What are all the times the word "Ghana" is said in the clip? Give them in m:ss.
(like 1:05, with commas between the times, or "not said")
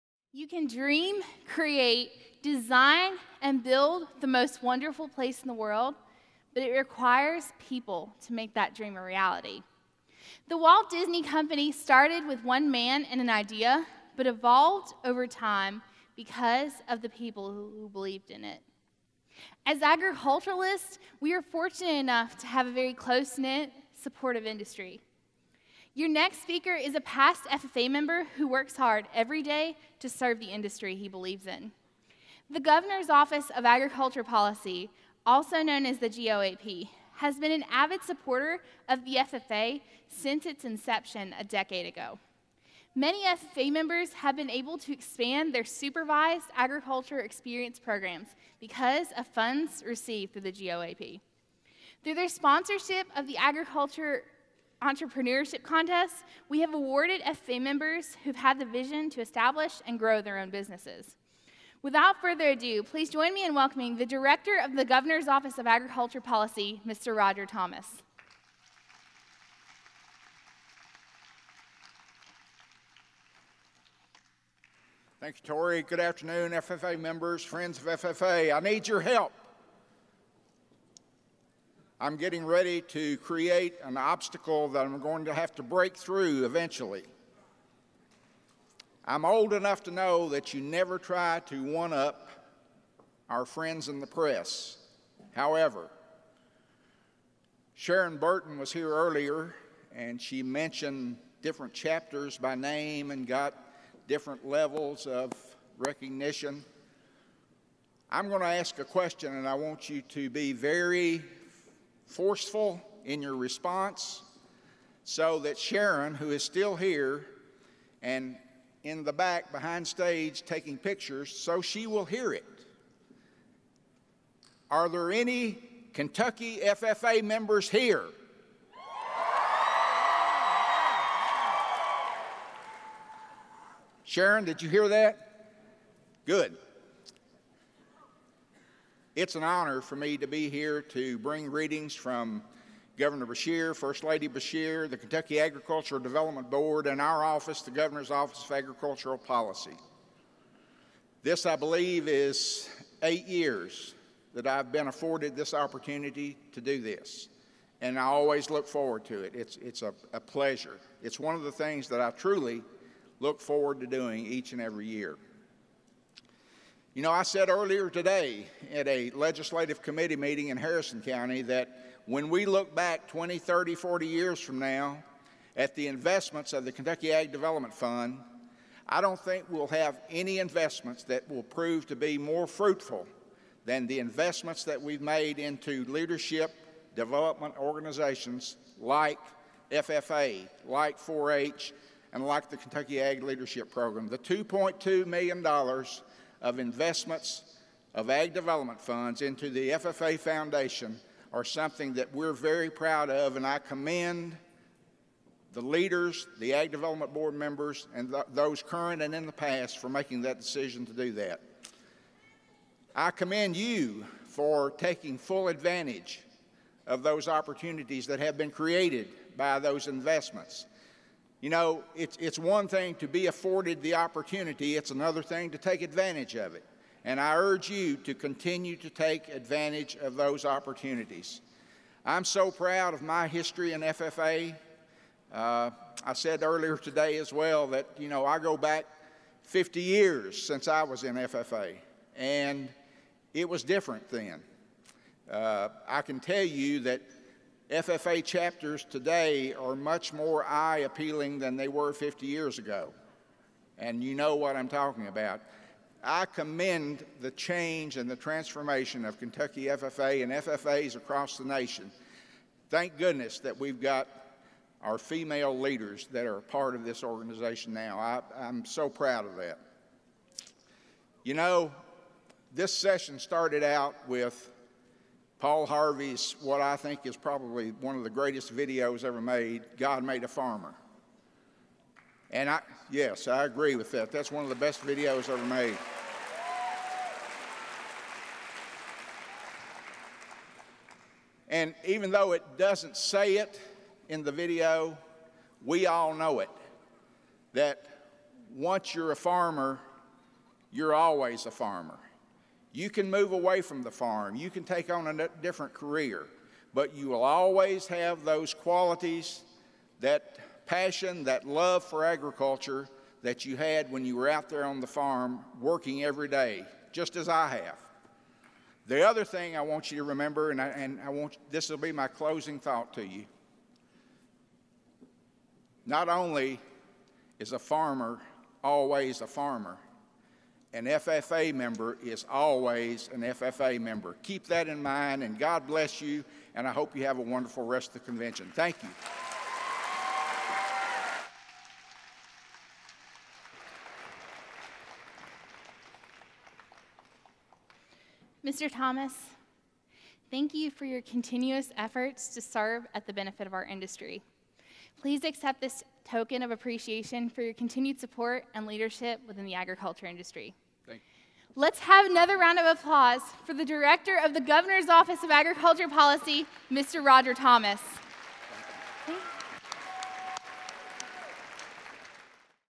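not said.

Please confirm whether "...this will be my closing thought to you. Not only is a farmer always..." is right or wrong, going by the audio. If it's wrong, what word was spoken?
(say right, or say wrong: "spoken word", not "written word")
right.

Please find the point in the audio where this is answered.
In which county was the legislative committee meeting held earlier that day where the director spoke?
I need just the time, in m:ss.
2:50.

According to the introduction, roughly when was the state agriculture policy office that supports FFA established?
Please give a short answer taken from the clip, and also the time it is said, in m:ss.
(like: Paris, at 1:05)
a decade ago, at 0:41.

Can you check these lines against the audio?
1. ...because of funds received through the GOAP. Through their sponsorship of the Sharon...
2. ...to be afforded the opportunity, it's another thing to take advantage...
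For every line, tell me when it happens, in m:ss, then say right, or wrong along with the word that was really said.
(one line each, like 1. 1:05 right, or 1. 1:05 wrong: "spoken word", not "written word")
1. 0:48 wrong: "Agriculture", not "Sharon"
2. 3:42 right.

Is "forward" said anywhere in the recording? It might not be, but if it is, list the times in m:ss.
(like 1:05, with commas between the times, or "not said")
2:38, 2:43.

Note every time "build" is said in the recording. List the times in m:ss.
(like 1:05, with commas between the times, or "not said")
0:03.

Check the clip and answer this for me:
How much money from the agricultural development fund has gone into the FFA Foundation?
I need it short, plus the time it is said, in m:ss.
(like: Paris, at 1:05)
$2.2 million, at 3:14.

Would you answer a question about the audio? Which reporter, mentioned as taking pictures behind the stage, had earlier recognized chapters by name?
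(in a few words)
Sharon Burton.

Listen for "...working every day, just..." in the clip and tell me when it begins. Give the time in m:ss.
5:15.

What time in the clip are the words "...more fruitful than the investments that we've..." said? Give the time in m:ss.
3:02.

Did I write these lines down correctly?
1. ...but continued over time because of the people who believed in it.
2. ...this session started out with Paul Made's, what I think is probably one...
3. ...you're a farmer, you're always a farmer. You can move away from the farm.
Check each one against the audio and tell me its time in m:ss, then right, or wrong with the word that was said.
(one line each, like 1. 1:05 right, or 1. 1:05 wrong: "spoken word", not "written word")
1. 0:14 wrong: "evolved", not "continued"
2. 4:32 wrong: "Harvey", not "Made"
3. 4:58 right.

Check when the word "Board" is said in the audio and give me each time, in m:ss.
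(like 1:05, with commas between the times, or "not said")
2:26, 3:27.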